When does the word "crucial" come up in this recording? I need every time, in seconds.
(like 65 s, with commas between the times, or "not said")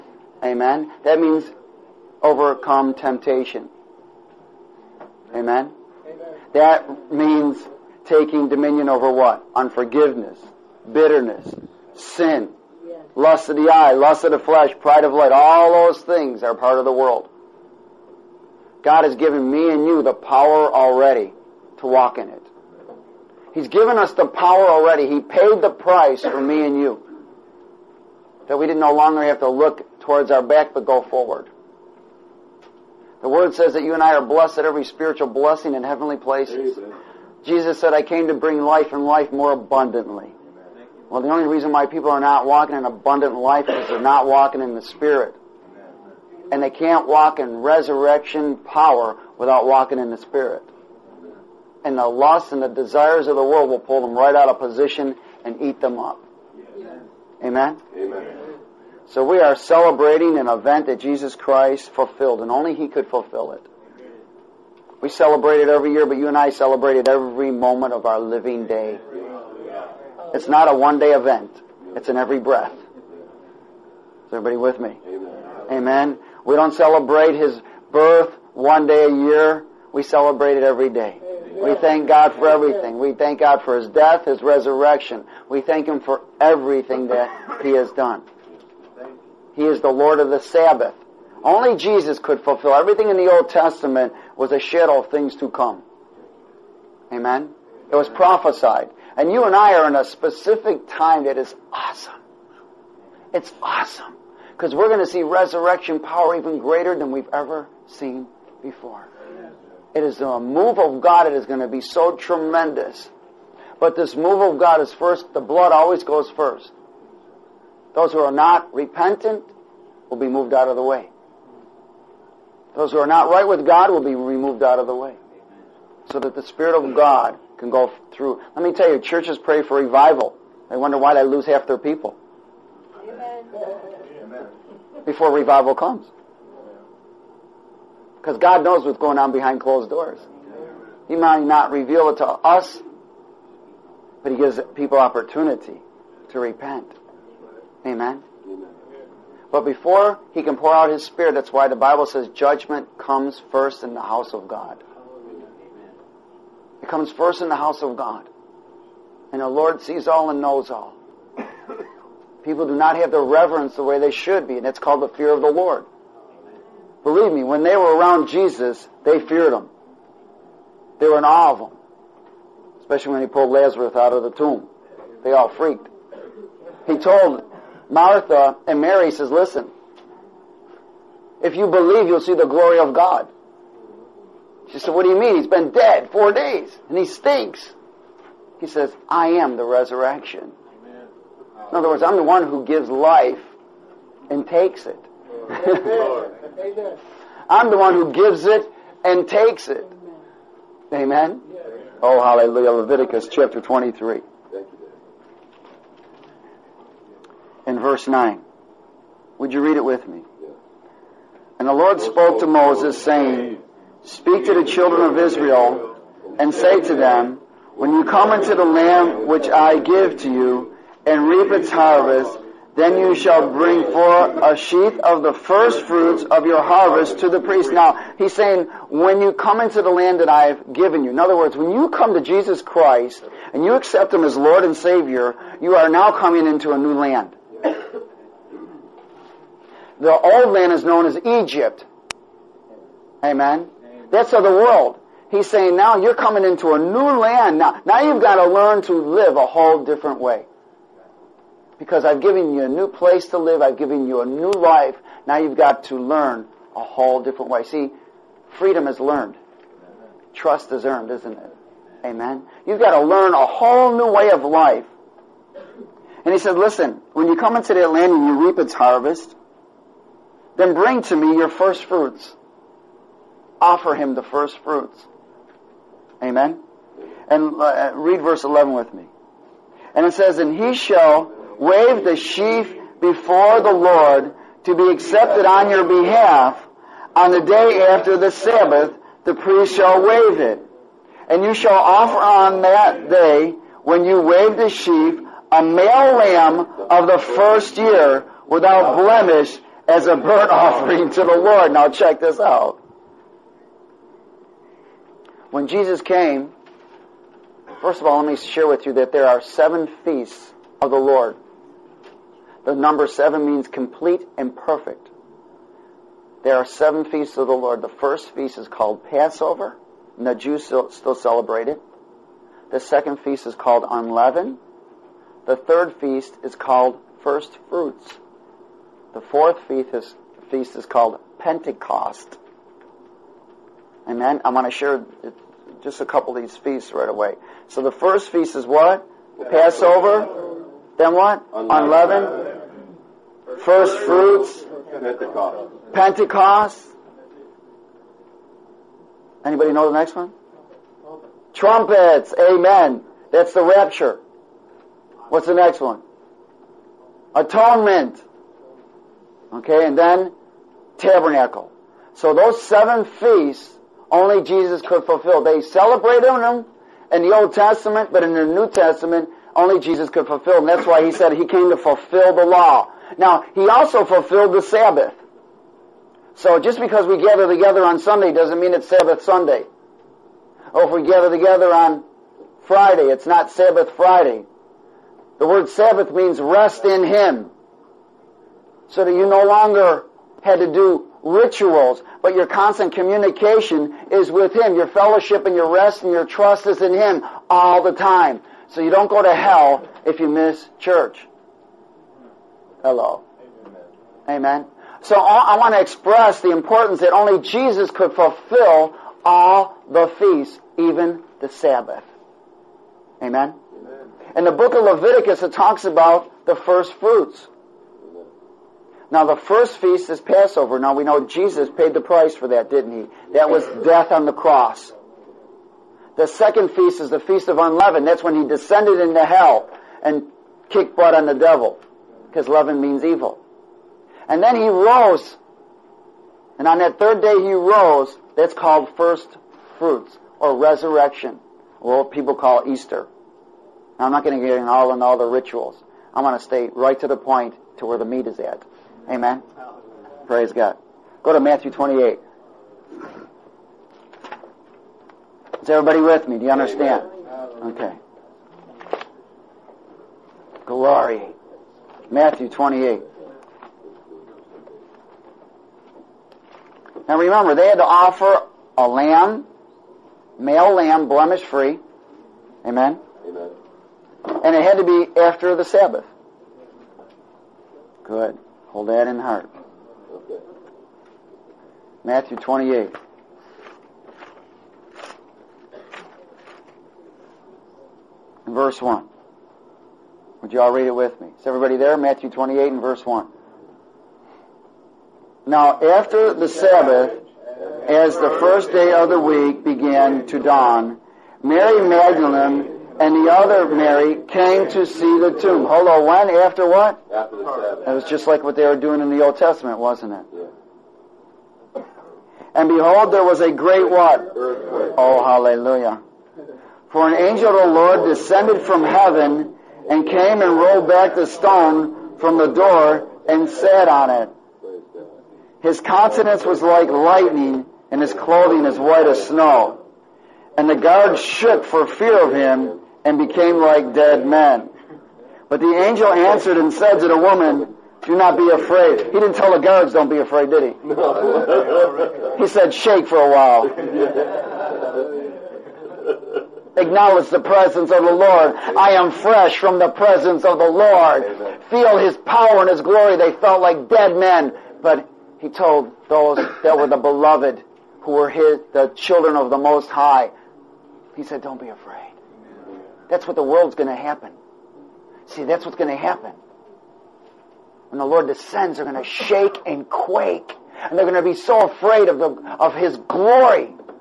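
not said.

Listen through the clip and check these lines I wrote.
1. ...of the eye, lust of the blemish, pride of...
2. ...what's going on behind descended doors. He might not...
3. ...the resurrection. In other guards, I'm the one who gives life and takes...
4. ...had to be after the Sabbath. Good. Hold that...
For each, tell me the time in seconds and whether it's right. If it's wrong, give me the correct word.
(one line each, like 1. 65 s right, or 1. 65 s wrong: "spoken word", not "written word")
1. 13 s wrong: "flesh", not "blemish"
2. 138 s wrong: "closed", not "descended"
3. 189 s wrong: "words", not "guards"
4. 474 s right.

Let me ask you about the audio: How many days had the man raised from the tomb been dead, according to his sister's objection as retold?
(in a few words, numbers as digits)
4.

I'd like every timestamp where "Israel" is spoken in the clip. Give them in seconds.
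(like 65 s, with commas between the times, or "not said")
215 s.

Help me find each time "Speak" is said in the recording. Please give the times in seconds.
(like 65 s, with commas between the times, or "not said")
214 s.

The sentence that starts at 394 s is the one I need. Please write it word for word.
Your fellowship and your rest and your trust is in Him all the time.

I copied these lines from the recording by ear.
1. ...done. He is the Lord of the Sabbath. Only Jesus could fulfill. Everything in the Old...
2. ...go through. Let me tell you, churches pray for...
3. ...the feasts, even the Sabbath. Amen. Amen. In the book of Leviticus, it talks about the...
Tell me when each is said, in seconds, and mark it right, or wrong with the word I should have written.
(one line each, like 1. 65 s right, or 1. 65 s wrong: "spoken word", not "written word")
1. 87 s right
2. 127 s right
3. 409 s right.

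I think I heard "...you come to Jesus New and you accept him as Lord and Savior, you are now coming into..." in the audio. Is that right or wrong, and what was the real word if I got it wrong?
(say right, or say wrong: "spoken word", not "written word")
wrong: "Christ", not "New".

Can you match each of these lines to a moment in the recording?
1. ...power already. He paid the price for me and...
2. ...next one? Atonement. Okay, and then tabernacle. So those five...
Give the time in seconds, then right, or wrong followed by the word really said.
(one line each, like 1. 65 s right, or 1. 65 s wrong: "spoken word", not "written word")
1. 24 s right
2. 355 s wrong: "seven", not "five".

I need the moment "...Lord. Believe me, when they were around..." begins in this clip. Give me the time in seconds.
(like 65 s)
165 s.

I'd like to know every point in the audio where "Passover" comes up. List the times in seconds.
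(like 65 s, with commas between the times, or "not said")
319 s, 339 s, 420 s.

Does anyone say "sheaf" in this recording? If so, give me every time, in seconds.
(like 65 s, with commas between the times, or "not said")
224 s, 282 s, 294 s.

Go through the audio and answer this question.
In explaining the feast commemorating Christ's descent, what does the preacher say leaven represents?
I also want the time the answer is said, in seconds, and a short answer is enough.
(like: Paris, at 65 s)
evil, at 433 s.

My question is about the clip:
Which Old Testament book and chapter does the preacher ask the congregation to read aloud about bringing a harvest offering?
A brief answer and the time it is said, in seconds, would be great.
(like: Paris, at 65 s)
Leviticus 23, at 202 s.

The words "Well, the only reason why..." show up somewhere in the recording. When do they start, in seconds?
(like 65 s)
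41 s.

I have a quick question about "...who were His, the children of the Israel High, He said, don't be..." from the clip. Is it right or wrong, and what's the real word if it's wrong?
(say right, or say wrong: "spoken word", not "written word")
wrong: "Most", not "Israel".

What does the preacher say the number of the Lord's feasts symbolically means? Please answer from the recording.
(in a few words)
complete and perfect.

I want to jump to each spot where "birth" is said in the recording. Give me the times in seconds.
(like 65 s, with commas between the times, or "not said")
77 s.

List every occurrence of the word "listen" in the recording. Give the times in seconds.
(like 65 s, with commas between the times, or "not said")
179 s, 266 s.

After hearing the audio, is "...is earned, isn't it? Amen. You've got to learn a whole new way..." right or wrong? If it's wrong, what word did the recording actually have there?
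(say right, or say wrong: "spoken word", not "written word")
right.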